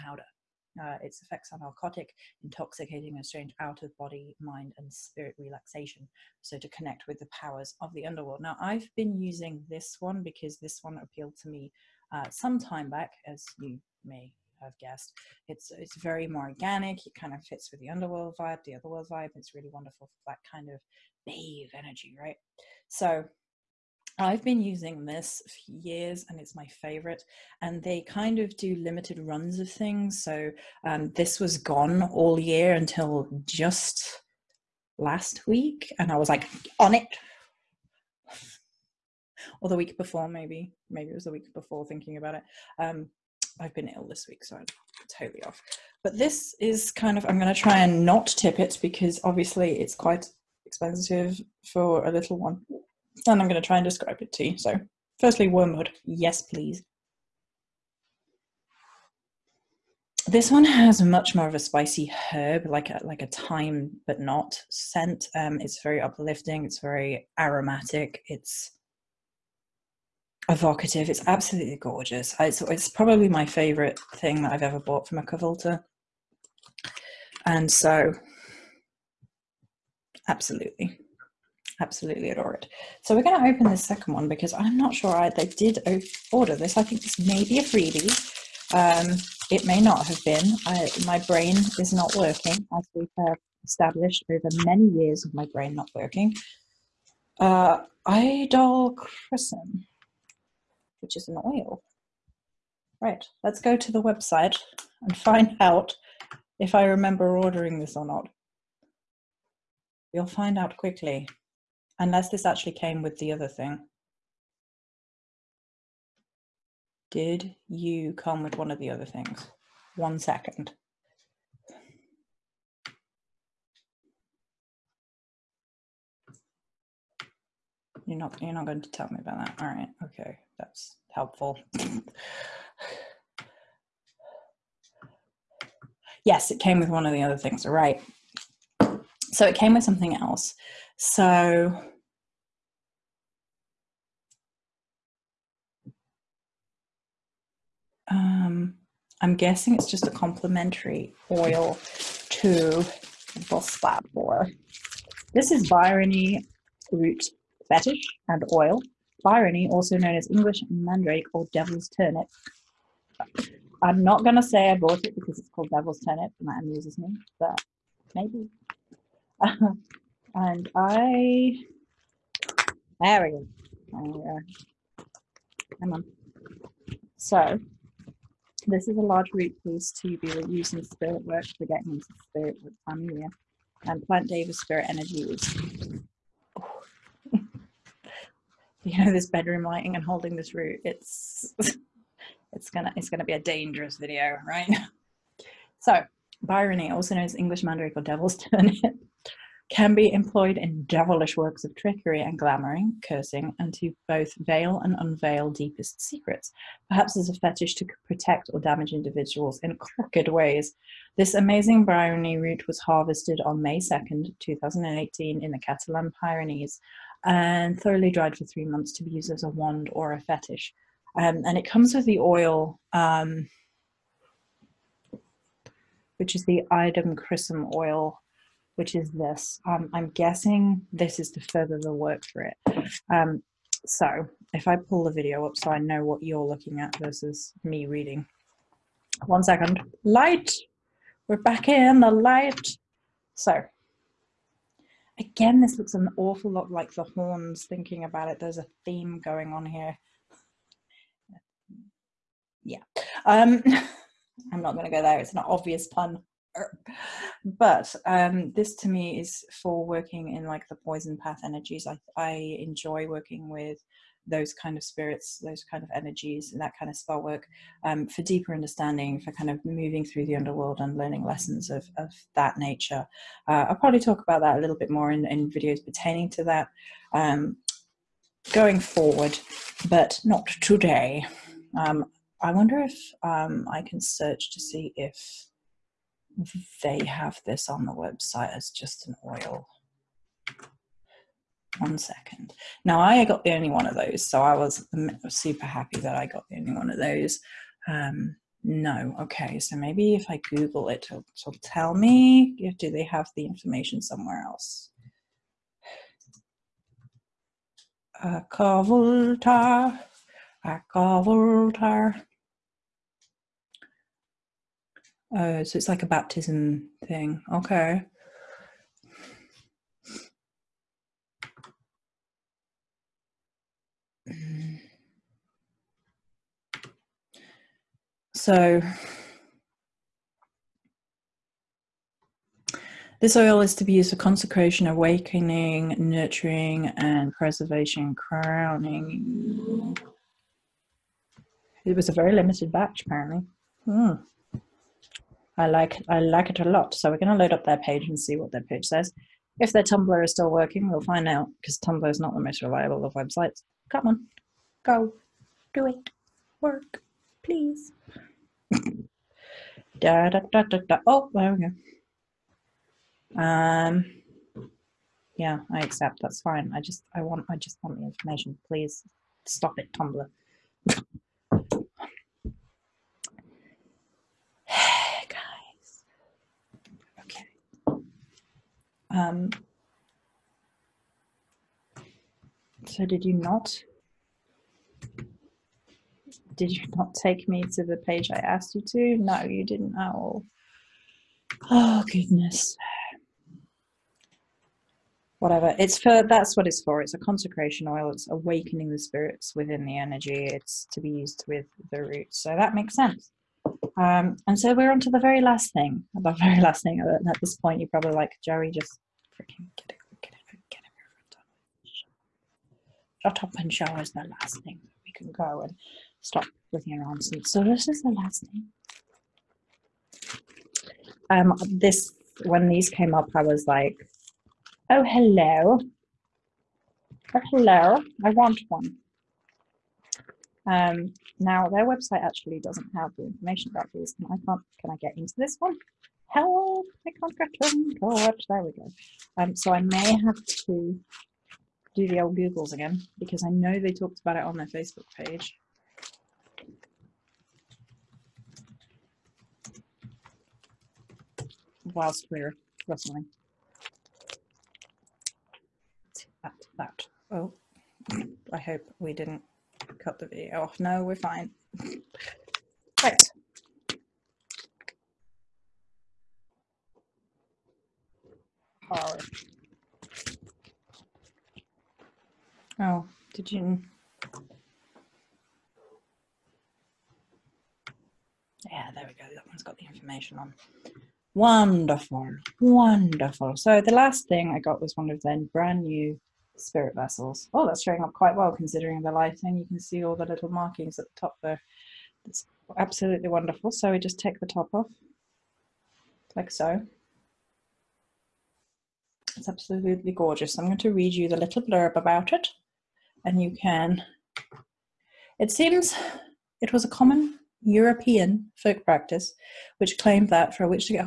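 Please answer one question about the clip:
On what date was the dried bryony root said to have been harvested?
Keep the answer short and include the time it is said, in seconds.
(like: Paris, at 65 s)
May 2nd, 2018, at 213 s.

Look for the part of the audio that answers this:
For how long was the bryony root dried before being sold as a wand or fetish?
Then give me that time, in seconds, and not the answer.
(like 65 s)
218 s.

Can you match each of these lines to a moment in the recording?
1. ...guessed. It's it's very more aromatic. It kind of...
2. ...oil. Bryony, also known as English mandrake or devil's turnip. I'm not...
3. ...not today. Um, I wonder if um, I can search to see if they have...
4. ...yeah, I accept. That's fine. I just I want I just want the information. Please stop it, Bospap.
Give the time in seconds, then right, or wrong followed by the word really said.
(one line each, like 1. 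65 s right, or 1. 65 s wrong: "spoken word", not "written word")
1. 14 s wrong: "organic", not "aromatic"
2. 158 s right
3. 280 s right
4. 365 s wrong: "Tumblr", not "Bospap".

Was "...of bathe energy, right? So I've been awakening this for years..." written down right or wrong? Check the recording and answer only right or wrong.
wrong.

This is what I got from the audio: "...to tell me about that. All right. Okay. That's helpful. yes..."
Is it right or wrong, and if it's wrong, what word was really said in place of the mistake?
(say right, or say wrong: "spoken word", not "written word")
right.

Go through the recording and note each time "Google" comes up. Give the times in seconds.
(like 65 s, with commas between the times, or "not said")
300 s, 442 s.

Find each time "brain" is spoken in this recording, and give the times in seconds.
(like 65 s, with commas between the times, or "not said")
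91 s, 95 s.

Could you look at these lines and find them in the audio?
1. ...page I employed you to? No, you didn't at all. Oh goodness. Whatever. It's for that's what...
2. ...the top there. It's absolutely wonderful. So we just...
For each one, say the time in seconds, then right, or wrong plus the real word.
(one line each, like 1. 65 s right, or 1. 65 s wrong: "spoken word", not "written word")
1. 387 s wrong: "asked", not "employed"
2. 491 s right.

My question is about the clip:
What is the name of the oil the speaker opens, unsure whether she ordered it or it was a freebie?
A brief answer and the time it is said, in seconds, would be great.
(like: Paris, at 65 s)
Idol Crescent, at 98 s.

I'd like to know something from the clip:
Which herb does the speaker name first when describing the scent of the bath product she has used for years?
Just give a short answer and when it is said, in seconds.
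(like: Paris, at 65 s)
Wormwood, at 55 s.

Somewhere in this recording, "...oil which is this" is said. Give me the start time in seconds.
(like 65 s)
227 s.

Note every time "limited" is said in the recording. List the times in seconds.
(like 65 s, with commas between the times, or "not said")
28 s, 342 s.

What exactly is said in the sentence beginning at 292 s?
Now I got the only one of those, so I was super happy that I got the only one of those.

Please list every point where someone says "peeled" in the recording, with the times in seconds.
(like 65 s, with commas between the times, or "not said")
not said.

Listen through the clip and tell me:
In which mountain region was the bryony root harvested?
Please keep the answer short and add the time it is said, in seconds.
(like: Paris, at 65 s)
Catalan Pyrenees, at 215 s.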